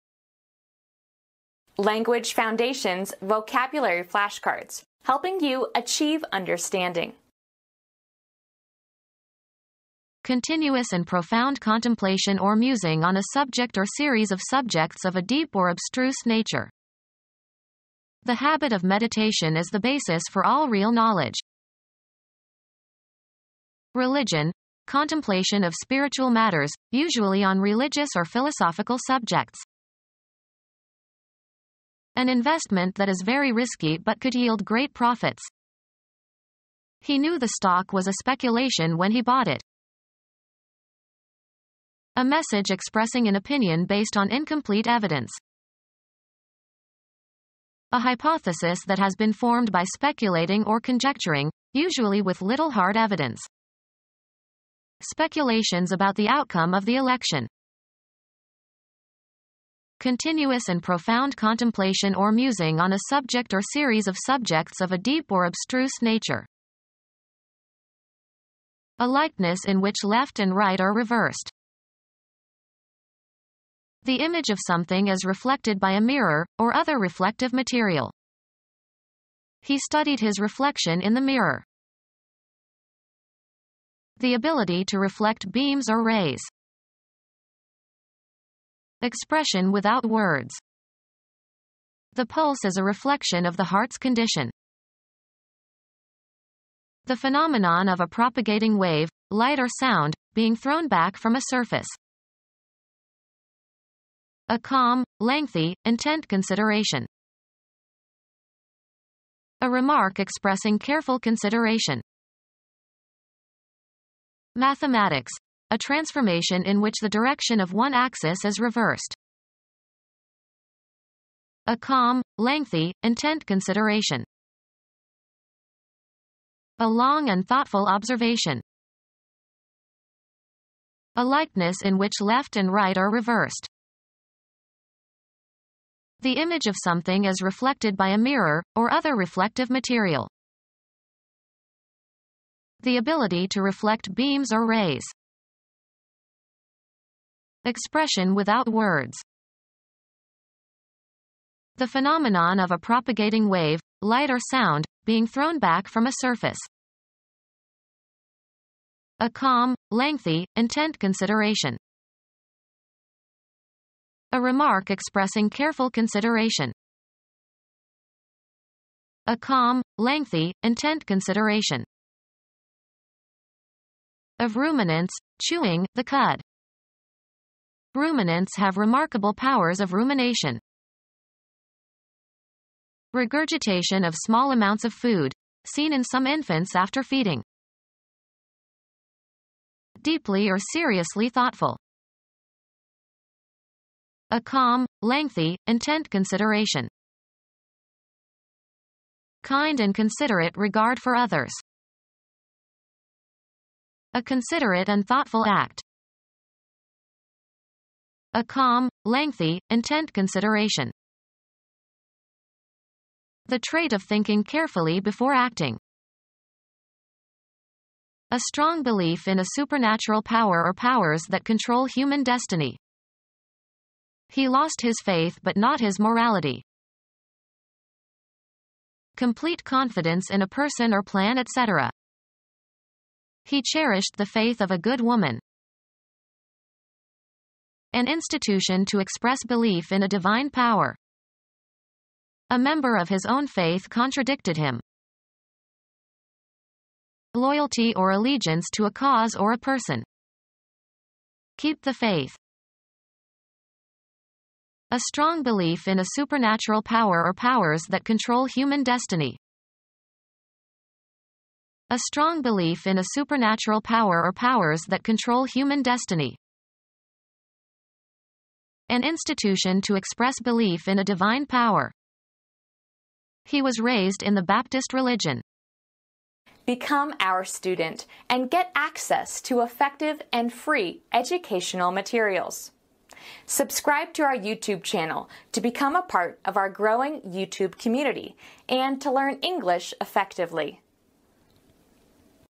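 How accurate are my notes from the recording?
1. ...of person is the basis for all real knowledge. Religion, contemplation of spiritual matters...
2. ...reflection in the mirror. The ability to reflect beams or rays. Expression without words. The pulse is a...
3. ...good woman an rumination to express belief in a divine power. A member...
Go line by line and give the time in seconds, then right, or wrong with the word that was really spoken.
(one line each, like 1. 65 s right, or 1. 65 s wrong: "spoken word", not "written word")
1. 18 s wrong: "meditation", not "person"
2. 80 s right
3. 234 s wrong: "institution", not "rumination".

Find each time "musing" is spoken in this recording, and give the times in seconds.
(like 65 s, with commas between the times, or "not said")
12 s, 62 s.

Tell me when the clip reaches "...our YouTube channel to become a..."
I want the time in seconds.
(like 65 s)
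284 s.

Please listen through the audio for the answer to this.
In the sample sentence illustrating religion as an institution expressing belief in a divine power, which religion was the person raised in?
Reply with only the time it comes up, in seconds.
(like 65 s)
274 s.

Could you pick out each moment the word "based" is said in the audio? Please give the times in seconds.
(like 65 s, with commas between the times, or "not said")
43 s.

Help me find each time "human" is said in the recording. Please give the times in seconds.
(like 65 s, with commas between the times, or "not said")
221 s, 258 s, 265 s.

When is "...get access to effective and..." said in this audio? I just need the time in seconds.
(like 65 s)
278 s.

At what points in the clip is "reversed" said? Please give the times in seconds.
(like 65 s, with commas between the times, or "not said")
70 s, 118 s, 133 s.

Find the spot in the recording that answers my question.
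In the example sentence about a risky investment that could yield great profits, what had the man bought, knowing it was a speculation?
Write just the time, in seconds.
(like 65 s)
37 s.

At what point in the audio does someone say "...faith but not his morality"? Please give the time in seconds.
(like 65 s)
225 s.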